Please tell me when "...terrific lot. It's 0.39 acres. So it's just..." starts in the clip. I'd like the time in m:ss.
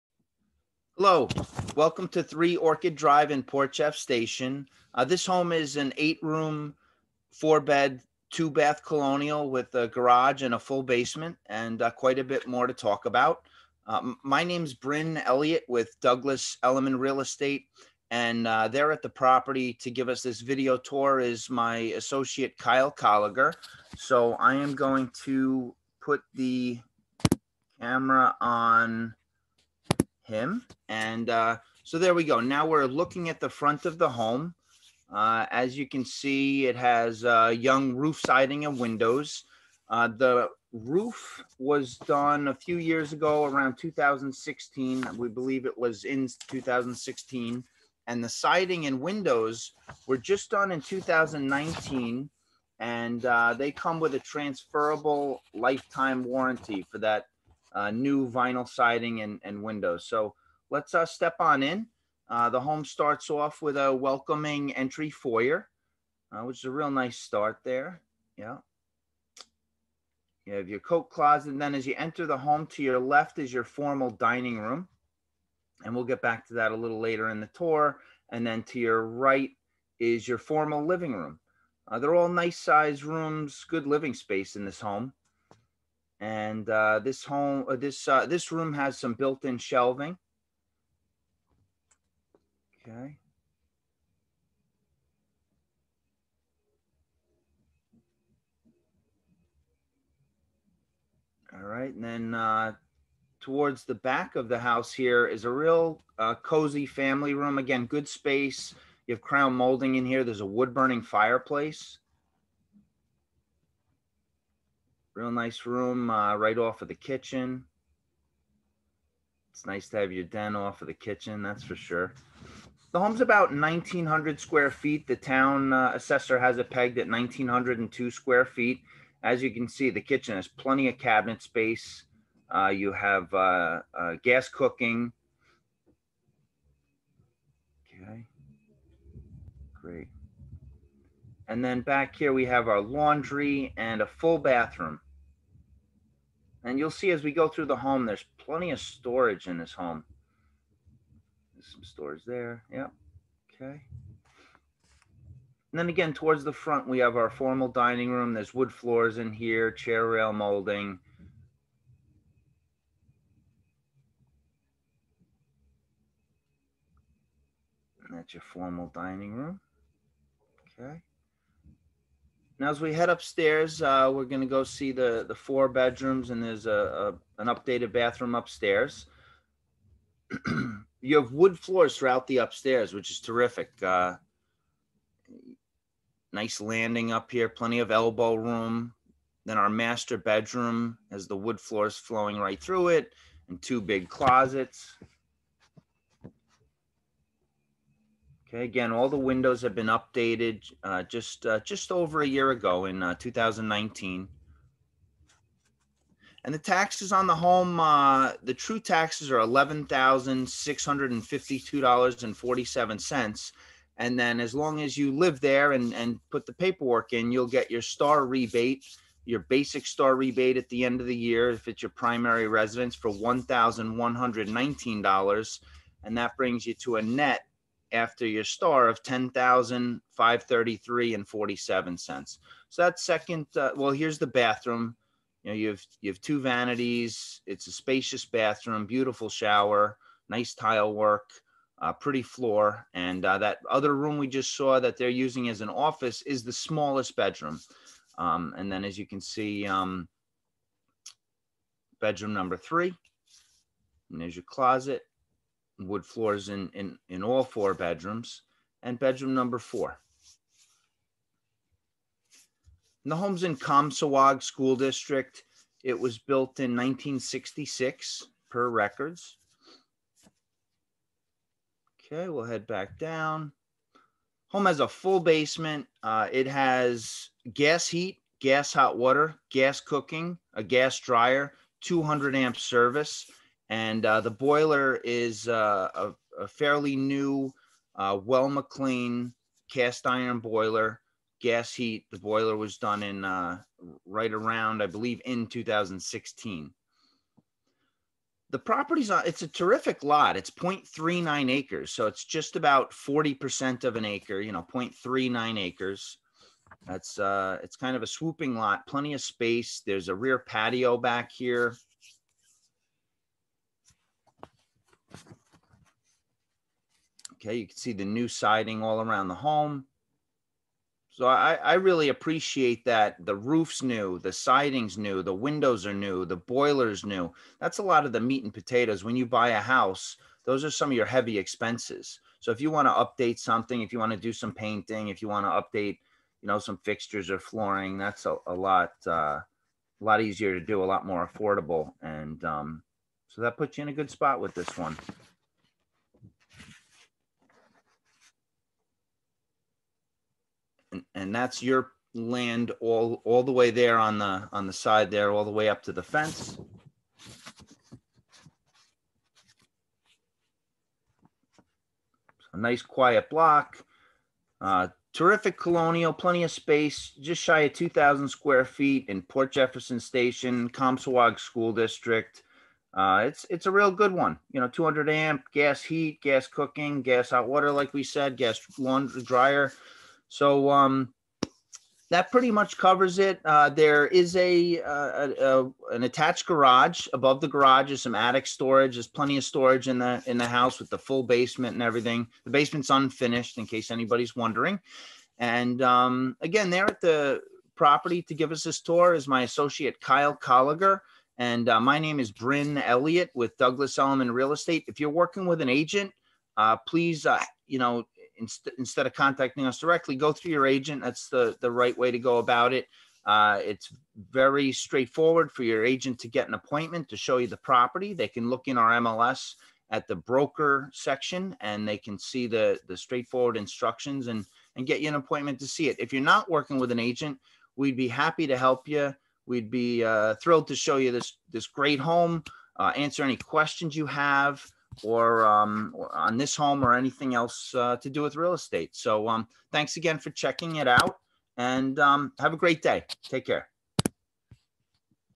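4:59.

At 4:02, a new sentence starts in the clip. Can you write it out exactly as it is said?
And uh, that other room we just saw that they're using as an office is the smallest bedroom.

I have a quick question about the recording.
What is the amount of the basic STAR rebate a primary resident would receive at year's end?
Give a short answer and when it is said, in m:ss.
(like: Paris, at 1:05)
$1,119, at 3:43.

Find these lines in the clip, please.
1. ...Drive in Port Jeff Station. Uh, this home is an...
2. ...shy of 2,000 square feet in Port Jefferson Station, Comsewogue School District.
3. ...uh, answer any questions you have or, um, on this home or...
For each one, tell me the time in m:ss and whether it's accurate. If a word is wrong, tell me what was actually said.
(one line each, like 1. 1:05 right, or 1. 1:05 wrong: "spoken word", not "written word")
1. 0:02 right
2. 6:07 right
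3. 7:12 right.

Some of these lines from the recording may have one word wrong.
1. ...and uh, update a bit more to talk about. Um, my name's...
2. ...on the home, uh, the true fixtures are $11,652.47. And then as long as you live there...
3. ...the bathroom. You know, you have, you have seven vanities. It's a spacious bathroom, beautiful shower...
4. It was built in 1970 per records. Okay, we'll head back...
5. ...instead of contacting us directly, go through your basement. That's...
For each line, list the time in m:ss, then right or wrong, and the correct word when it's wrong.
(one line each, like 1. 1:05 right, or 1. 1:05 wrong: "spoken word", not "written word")
1. 0:11 wrong: "quite", not "update"
2. 3:27 wrong: "taxes", not "fixtures"
3. 3:54 wrong: "two", not "seven"
4. 4:25 wrong: "1966", not "1970"
5. 6:48 wrong: "agent", not "basement".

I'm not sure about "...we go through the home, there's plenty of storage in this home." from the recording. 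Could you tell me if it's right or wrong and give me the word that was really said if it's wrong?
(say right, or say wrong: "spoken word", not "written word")
right.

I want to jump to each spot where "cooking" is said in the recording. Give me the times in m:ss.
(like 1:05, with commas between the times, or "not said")
2:14, 4:39, 6:16.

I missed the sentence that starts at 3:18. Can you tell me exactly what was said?
Okay, again, all the windows have been updated uh, just uh, just over a year ago in uh, 2019.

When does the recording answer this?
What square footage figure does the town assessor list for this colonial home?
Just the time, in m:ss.
2:07.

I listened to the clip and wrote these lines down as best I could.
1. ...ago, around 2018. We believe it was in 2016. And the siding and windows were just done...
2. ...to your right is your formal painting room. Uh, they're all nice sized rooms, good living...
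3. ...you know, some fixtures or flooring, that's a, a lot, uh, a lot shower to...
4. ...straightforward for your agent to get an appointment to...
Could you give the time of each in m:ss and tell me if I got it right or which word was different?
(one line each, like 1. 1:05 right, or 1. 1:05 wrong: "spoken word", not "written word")
1. 0:43 wrong: "2016", not "2018"
2. 1:18 wrong: "living", not "painting"
3. 5:36 wrong: "easier", not "shower"
4. 6:54 right.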